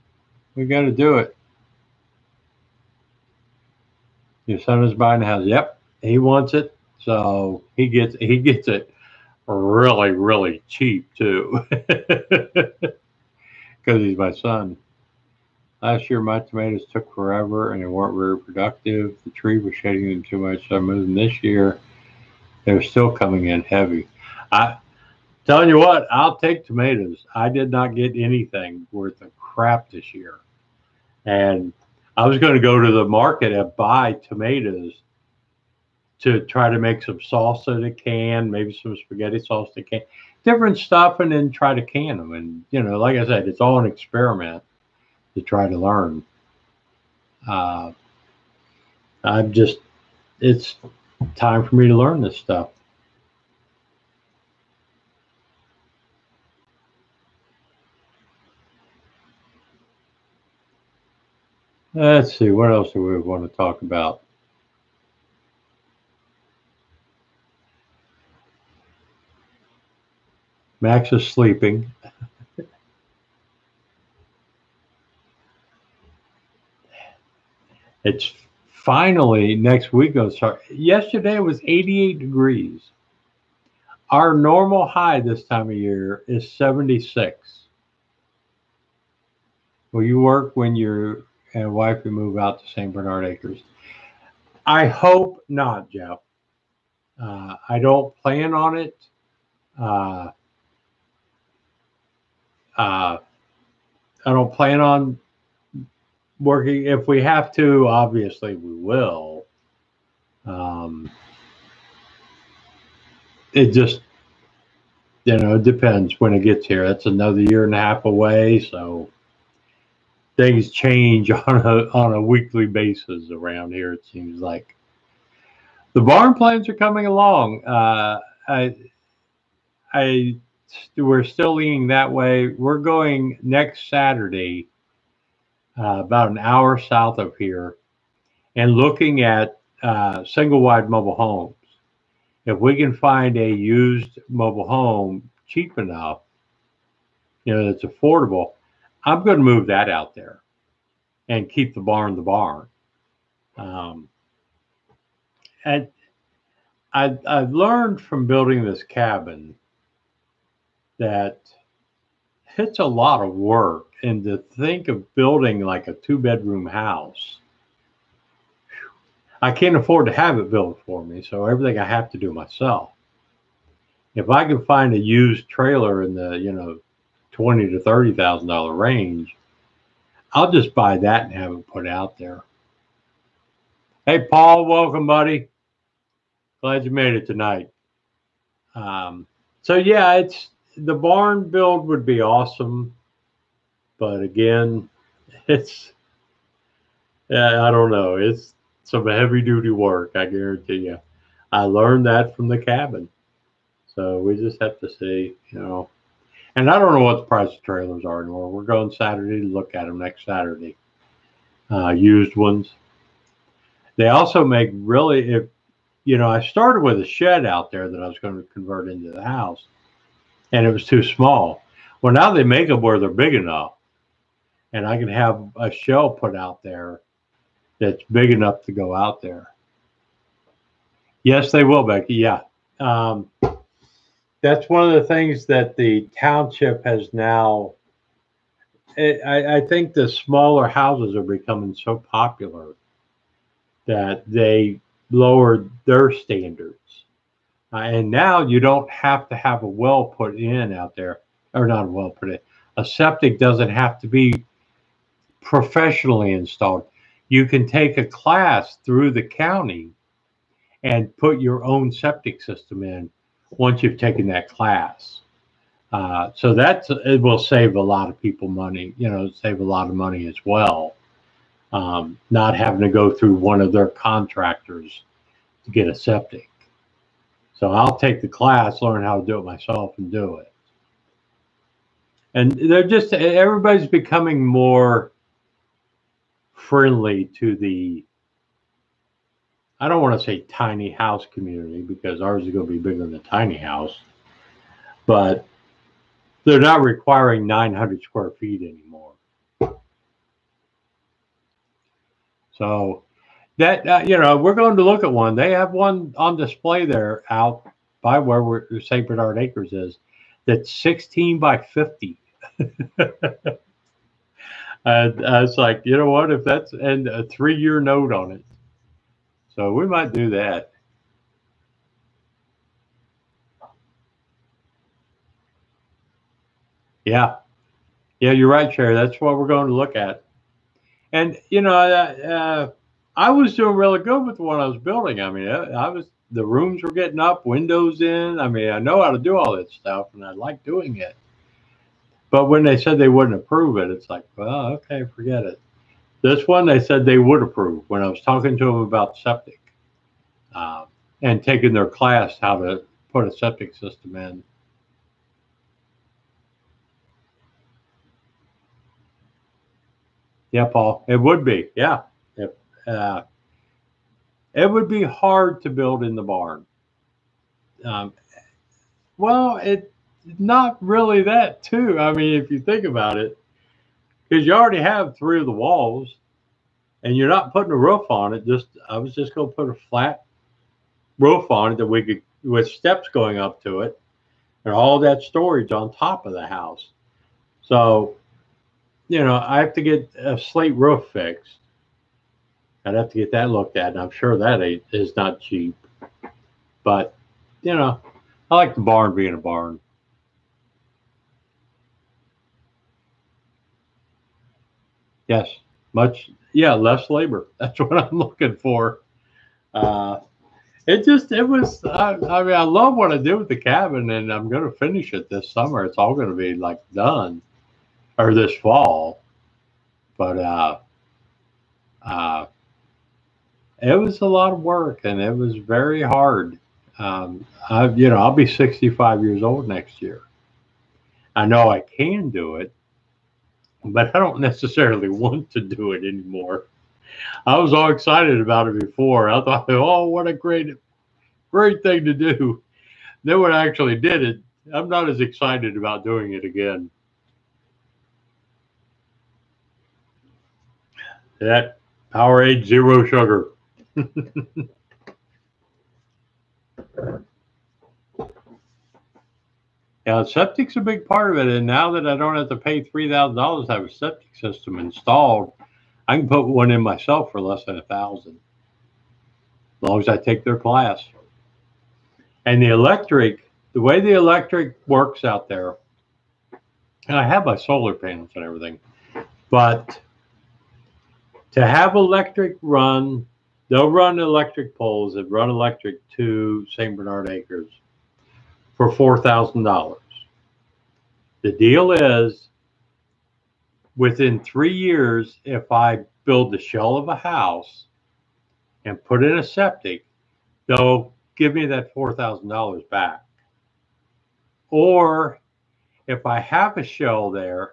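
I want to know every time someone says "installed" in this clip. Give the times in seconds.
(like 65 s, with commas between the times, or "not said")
256 s, 464 s.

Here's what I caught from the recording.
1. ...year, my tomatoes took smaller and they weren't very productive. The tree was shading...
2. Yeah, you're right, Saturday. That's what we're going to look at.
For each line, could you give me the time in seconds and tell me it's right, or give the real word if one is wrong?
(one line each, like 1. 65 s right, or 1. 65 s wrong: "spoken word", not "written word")
1. 16 s wrong: "forever", not "smaller"
2. 328 s wrong: "Sherry", not "Saturday".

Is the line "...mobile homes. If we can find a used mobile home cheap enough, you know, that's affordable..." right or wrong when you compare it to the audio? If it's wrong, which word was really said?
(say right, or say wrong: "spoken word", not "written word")
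right.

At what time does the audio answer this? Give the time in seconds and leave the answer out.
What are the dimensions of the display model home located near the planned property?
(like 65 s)
310 s.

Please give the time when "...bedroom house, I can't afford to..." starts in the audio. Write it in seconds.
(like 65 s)
166 s.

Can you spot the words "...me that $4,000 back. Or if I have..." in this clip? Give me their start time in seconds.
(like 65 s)
501 s.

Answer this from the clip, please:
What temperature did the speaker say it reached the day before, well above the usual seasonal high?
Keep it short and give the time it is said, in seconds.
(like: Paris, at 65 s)
88 degrees, at 81 s.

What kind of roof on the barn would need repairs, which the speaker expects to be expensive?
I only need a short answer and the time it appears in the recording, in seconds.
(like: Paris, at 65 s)
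slate roof, at 390 s.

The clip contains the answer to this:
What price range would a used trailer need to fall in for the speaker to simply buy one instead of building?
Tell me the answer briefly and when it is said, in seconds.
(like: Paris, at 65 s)
$20,000 to $30,000, at 177 s.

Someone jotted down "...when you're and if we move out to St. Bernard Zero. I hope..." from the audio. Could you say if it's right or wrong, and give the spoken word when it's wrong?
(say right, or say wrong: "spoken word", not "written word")
wrong: "Acres", not "Zero".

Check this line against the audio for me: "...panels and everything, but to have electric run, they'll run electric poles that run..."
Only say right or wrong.
right.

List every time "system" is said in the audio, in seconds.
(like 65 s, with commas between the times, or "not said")
262 s, 353 s, 464 s.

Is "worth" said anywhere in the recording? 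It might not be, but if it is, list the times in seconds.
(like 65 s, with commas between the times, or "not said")
28 s.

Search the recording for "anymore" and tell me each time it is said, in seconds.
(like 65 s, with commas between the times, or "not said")
208 s, 298 s, 436 s.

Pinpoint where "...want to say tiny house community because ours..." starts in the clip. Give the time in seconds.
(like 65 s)
290 s.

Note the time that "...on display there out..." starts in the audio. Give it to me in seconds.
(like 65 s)
306 s.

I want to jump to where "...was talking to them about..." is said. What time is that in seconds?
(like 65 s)
348 s.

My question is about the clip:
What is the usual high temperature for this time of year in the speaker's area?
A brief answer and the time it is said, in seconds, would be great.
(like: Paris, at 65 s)
76, at 86 s.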